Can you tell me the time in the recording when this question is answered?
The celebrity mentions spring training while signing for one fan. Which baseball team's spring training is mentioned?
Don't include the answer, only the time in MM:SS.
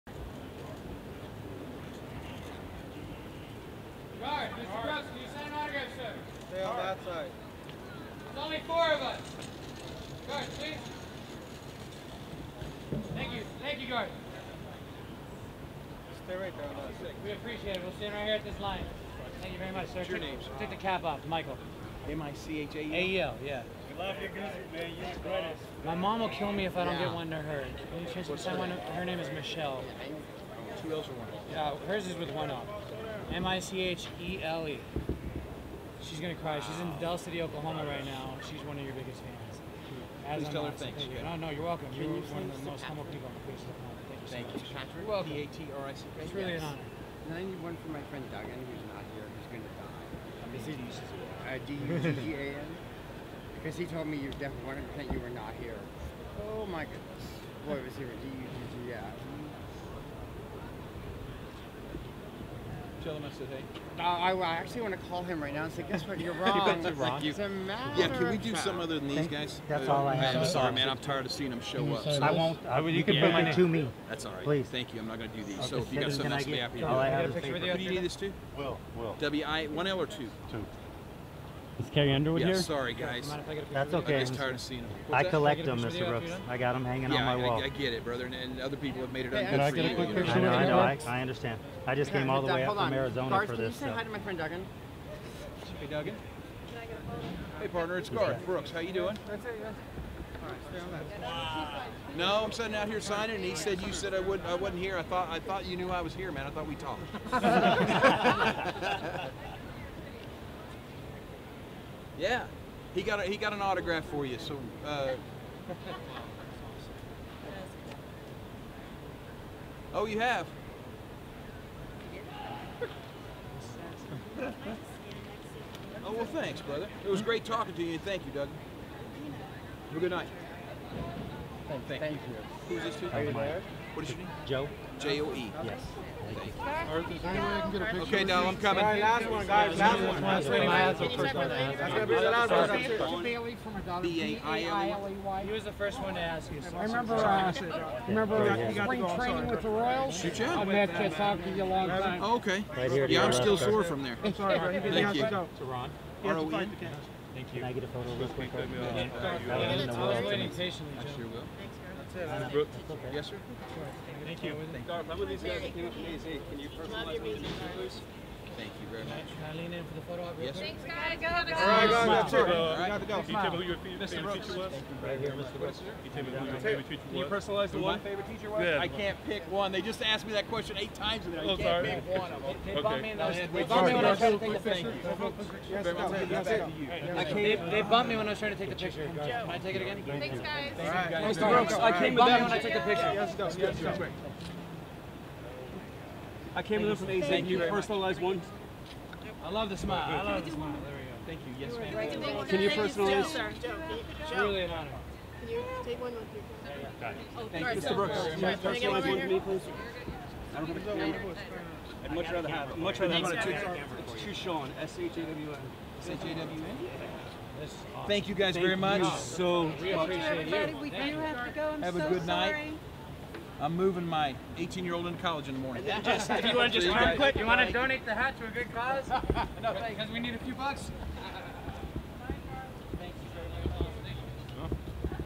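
02:29.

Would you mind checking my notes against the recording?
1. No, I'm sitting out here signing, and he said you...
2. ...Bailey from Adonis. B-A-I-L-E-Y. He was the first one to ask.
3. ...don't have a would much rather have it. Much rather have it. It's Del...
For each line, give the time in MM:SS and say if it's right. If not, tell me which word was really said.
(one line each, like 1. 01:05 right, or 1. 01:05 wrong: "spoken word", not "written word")
1. 01:42 right
2. 02:23 right
3. 03:30 wrong: "Chushawn", not "Del".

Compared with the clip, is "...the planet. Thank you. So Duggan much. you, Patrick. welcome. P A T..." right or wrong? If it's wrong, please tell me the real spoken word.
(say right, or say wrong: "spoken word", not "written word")
wrong: "Thank", not "Duggan".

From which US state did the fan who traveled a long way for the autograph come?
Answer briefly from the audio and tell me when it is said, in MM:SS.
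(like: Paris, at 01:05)
Arizona, at 01:32.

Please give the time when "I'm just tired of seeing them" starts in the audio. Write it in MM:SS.
01:24.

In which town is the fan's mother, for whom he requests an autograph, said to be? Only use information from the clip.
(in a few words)
Del City, Oklahoma.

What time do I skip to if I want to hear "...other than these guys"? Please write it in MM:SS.
01:08.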